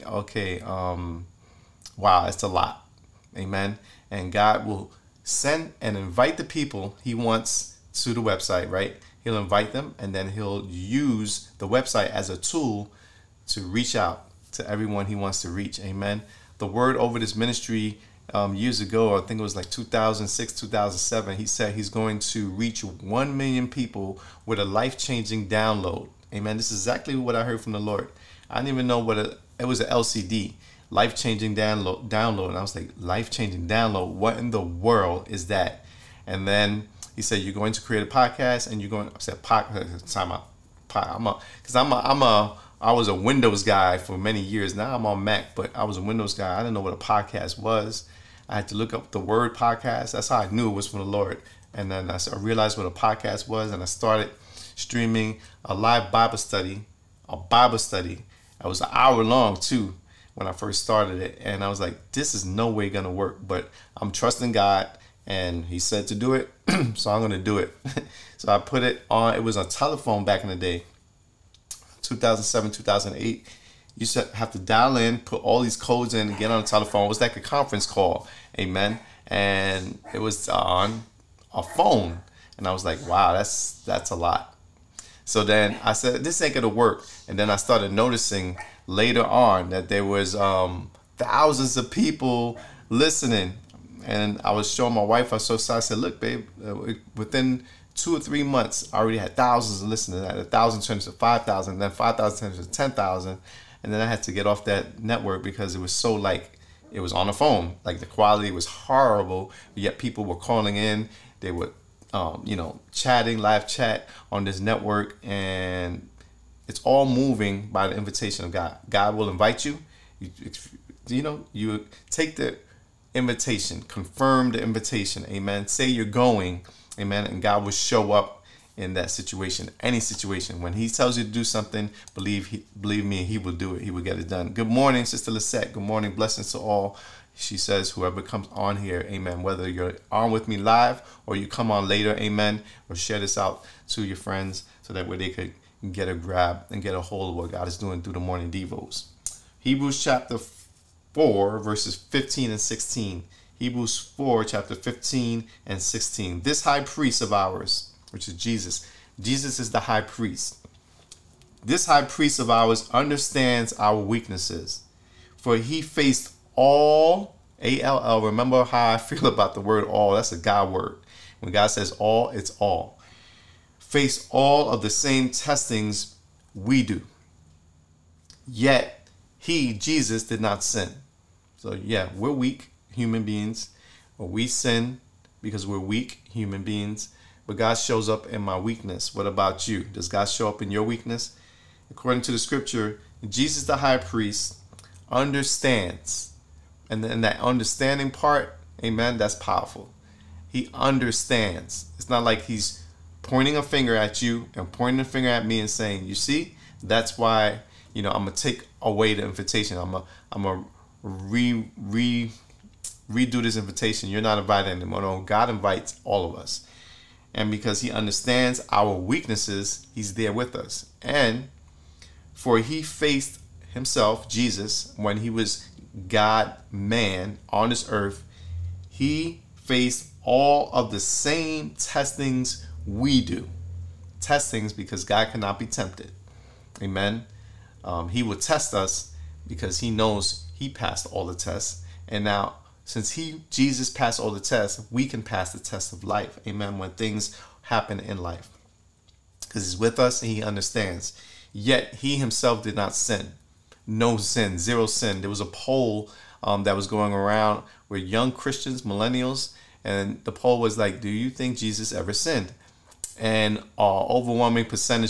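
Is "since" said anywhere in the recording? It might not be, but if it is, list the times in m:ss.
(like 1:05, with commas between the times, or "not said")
4:02.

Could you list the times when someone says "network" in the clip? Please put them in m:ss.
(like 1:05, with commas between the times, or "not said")
1:45, 1:54.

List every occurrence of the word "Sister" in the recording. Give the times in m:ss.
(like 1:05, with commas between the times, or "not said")
2:15.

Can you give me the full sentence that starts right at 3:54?
Testings because God cannot be tempted.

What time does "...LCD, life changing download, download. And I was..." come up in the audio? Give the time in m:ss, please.
0:29.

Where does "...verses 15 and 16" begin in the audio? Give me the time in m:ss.
2:31.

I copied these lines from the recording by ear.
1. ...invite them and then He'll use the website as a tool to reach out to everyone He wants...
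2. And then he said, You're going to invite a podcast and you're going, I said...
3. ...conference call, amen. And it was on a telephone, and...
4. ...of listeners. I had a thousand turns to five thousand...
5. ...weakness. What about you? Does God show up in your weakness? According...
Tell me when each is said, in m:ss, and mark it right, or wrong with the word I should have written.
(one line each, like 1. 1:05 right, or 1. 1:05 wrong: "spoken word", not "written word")
1. 0:09 right
2. 0:36 wrong: "create", not "invite"
3. 1:17 wrong: "phone", not "telephone"
4. 1:39 right
5. 3:08 right.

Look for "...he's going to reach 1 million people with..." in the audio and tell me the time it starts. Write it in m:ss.
0:21.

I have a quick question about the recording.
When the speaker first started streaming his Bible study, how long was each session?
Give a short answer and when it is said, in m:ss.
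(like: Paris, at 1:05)
an hour, at 0:58.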